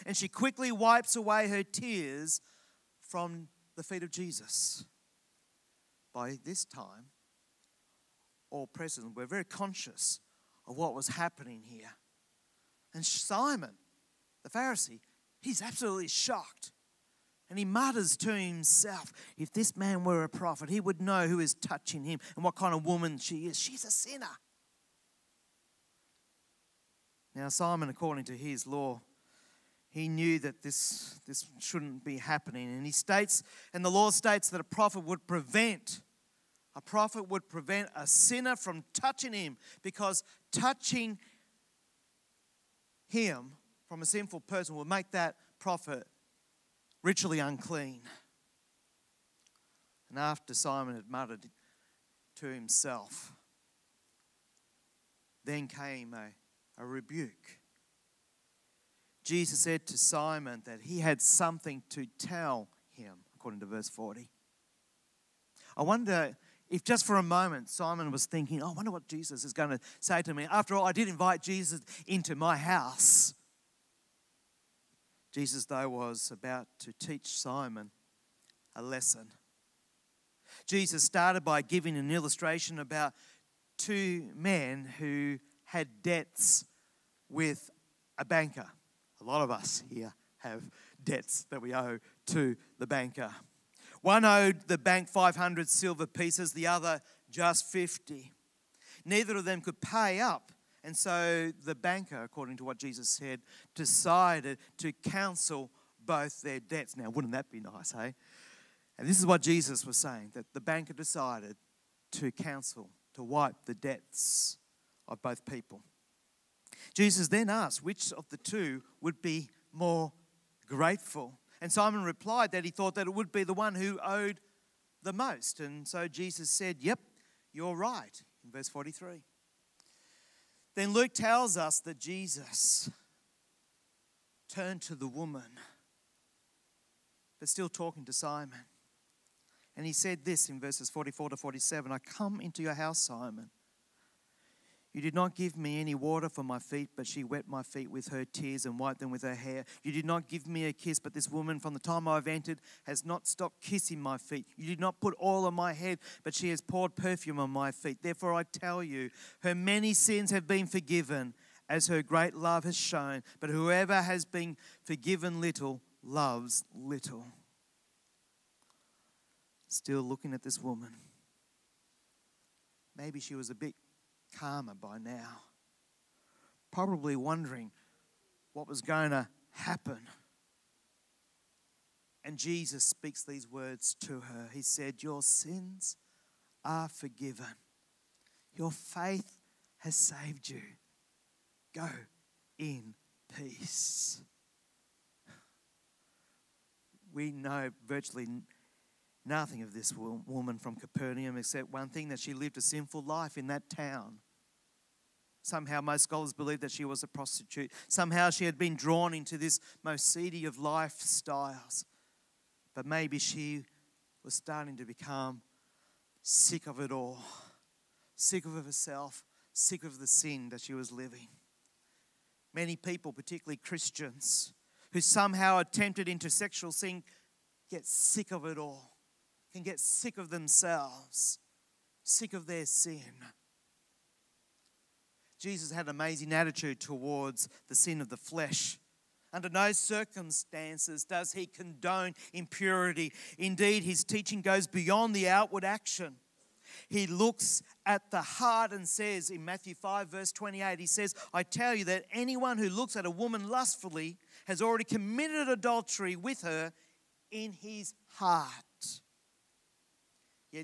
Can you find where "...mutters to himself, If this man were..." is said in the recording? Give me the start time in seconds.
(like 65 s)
17 s.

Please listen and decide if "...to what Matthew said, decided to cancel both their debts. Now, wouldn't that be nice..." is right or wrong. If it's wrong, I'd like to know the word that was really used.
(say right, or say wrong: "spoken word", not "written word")
wrong: "Jesus", not "Matthew".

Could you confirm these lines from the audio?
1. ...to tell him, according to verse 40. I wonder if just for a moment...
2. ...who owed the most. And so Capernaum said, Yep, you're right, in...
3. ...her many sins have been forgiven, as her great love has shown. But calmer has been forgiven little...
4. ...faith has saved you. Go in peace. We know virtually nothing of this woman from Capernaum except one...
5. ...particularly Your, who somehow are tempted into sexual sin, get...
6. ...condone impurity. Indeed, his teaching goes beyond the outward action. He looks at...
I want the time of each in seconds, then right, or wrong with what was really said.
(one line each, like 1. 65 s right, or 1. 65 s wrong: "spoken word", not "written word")
1. 61 s right
2. 123 s wrong: "Jesus", not "Capernaum"
3. 159 s wrong: "whoever", not "calmer"
4. 188 s right
5. 223 s wrong: "Christians", not "Your"
6. 241 s right.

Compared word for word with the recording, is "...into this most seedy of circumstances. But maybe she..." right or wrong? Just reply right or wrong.
wrong.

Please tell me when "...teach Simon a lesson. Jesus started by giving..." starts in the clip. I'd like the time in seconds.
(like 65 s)
76 s.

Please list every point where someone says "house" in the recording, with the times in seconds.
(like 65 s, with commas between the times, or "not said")
72 s, 142 s.